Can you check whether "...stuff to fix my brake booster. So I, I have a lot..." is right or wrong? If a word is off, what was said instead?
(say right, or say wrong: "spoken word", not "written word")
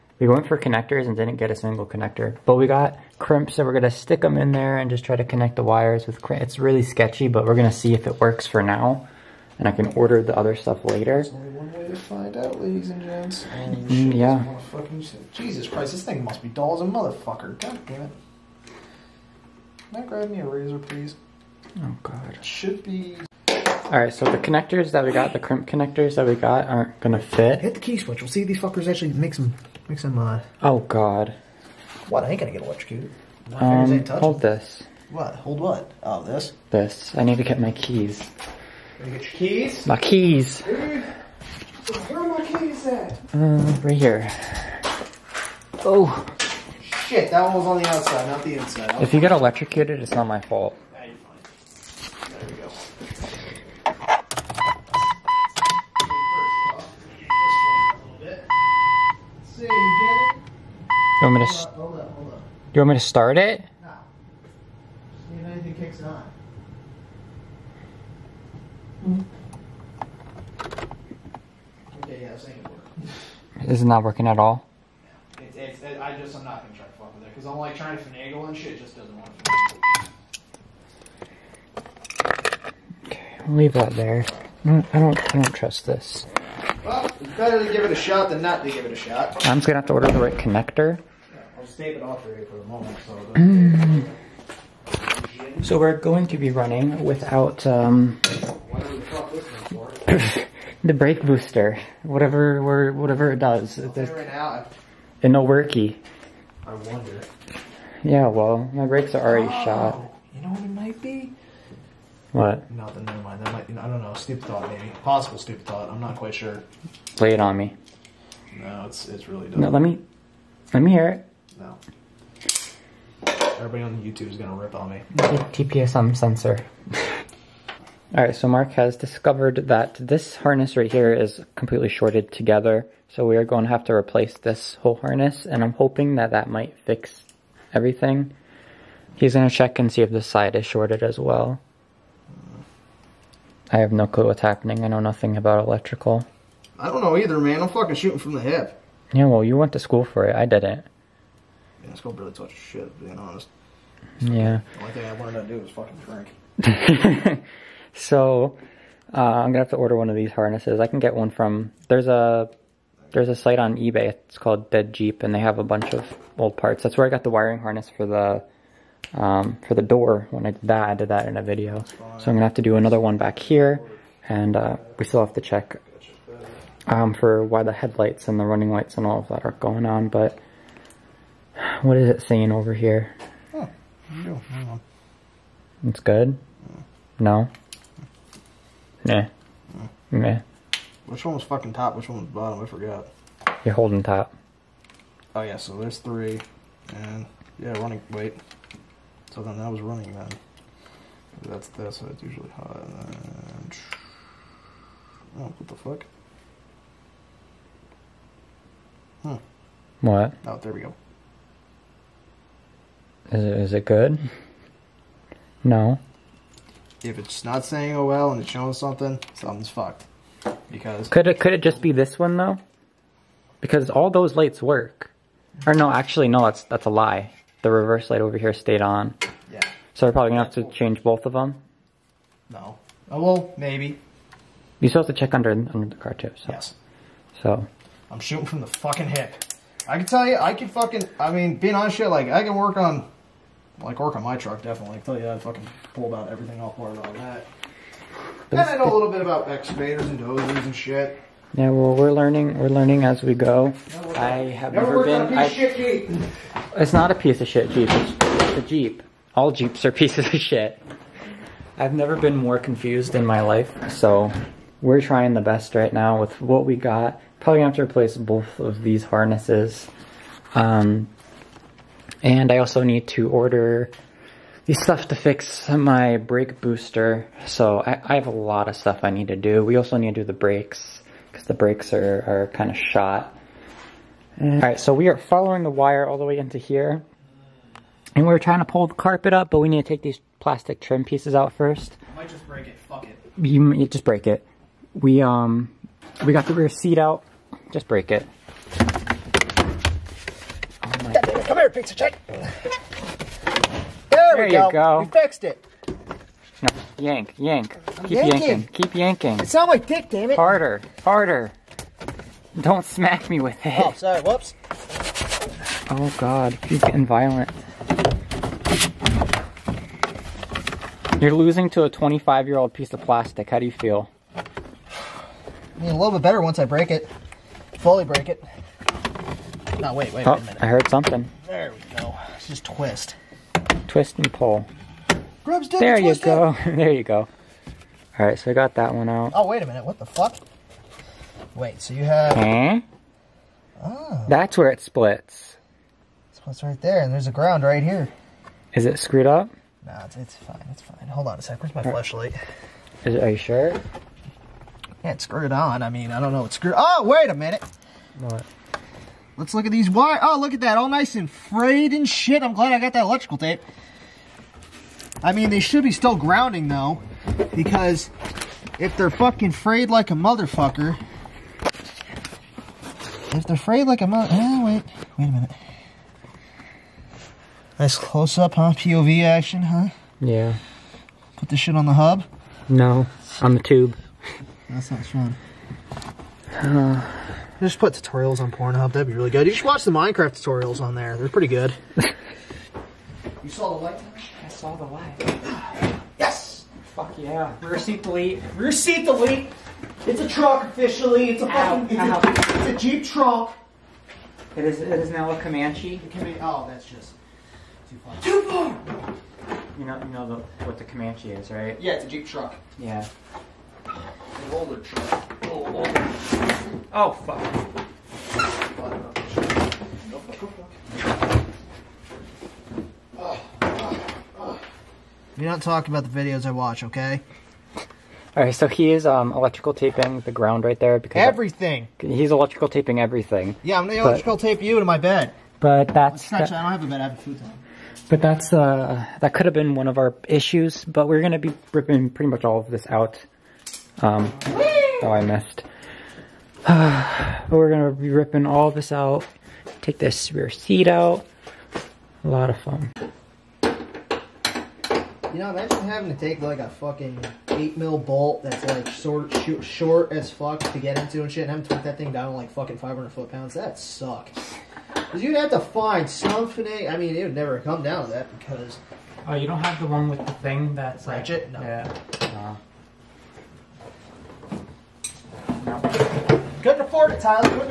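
right.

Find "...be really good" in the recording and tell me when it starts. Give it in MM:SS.
06:29.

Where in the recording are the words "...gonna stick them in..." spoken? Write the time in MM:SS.
00:03.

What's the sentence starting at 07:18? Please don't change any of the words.
But that's uh, that could have been one of our issues.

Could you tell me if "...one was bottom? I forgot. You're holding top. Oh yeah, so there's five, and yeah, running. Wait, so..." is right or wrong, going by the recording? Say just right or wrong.
wrong.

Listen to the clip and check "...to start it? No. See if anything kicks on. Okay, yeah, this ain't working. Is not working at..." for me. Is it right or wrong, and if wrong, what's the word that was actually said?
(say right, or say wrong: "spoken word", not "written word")
right.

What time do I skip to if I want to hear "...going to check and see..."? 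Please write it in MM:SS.
02:19.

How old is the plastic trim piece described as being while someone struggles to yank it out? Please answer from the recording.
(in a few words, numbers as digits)
25 years.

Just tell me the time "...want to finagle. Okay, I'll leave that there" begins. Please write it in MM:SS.
01:19.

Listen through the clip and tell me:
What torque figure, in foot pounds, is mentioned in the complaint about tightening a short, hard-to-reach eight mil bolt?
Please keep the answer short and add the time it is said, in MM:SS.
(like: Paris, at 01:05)
500 foot pounds, at 07:42.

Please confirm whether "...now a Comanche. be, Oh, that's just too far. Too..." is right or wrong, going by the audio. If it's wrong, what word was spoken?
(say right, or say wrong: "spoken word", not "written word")
right.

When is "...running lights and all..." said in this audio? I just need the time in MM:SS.
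02:58.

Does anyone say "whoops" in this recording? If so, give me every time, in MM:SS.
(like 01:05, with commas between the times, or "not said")
05:14.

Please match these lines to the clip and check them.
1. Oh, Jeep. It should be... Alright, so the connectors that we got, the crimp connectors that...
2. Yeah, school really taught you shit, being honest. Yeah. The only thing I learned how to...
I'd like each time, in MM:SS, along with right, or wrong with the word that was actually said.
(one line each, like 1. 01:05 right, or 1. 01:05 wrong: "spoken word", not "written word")
1. 00:21 wrong: "God", not "Jeep"
2. 02:31 right.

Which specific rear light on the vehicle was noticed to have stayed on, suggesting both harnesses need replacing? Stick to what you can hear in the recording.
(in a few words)
Reverse light.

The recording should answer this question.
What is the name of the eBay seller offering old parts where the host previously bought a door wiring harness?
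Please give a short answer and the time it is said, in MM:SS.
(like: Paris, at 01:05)
Dead Jeep, at 02:44.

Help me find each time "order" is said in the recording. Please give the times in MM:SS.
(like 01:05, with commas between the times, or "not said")
00:09, 01:29, 02:39, 04:33.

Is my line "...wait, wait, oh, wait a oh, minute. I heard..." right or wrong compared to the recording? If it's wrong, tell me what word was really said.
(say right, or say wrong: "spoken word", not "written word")
right.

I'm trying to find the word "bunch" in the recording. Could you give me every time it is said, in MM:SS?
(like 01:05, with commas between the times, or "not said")
02:45.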